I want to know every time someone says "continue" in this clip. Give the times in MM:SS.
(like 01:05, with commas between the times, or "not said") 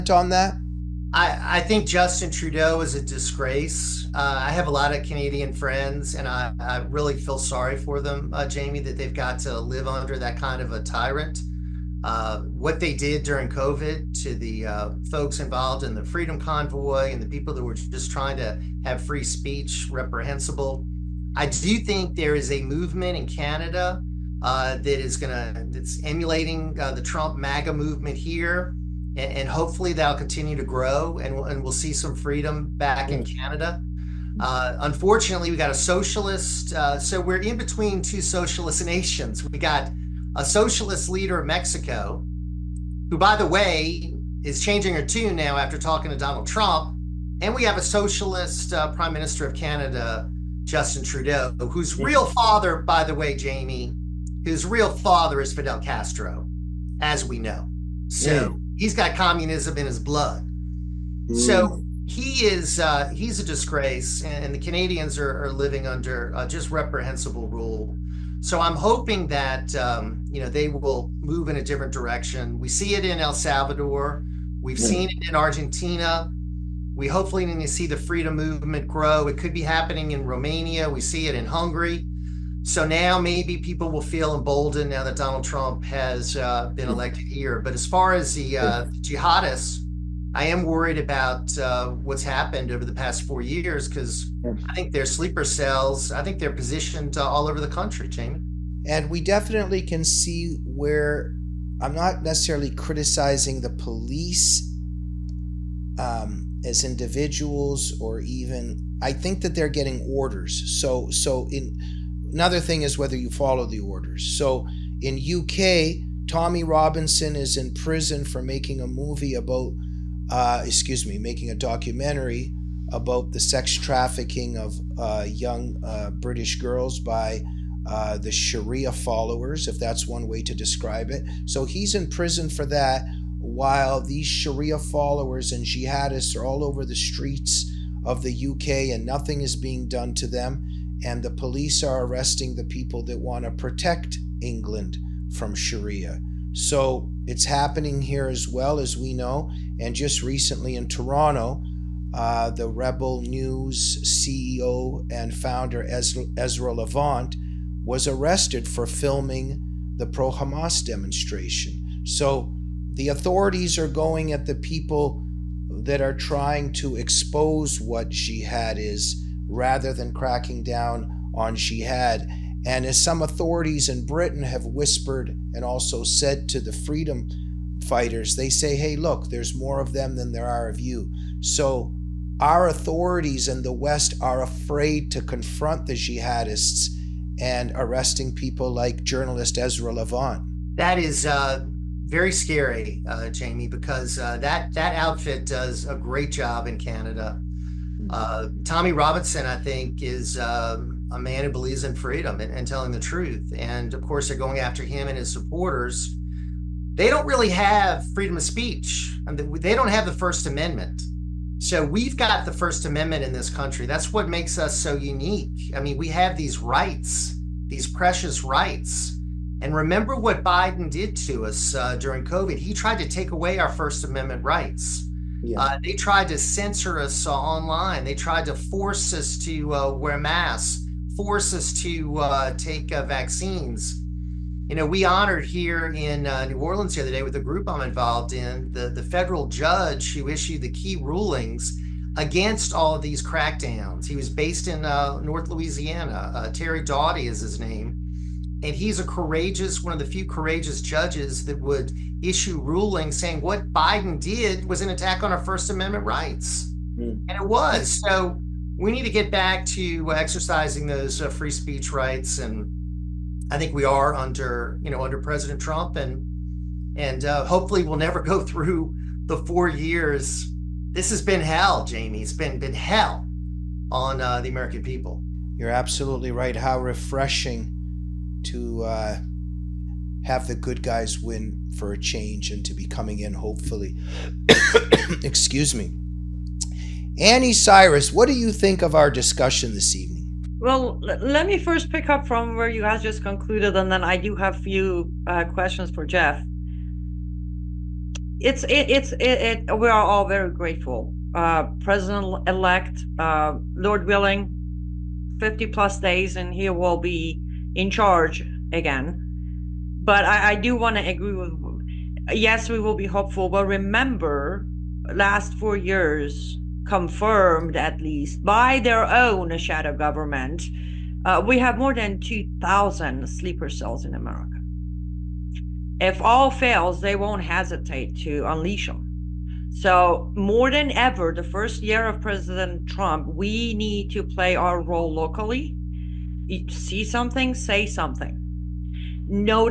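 00:30.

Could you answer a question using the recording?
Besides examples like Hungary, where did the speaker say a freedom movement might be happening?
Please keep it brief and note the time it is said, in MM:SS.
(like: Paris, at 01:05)
Romania, at 01:20.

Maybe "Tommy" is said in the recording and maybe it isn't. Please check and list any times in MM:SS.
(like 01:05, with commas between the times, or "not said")
01:56, 03:18.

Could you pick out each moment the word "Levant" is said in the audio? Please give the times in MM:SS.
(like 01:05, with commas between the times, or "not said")
02:36, 03:09.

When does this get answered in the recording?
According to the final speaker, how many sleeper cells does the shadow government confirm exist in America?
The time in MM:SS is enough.
05:21.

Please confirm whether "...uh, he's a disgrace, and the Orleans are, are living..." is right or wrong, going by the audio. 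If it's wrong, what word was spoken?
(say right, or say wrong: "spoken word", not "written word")
wrong: "Canadians", not "Orleans".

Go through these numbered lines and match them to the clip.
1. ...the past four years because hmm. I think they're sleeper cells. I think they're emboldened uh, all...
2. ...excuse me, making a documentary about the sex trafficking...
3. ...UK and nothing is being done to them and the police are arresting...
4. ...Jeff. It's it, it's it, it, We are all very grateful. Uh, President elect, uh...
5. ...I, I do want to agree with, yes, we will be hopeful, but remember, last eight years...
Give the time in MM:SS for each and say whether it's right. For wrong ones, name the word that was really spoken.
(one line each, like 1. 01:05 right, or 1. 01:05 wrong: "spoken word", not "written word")
1. 01:32 wrong: "positioned", not "emboldened"
2. 02:00 right
3. 02:18 right
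4. 04:56 right
5. 05:10 wrong: "four", not "eight".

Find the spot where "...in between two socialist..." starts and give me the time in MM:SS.
00:37.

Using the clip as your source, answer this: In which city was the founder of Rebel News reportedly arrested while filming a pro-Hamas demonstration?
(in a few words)
Toronto.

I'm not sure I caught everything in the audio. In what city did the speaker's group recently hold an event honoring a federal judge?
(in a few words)
New Orleans.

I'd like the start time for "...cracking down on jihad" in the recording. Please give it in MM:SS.
02:50.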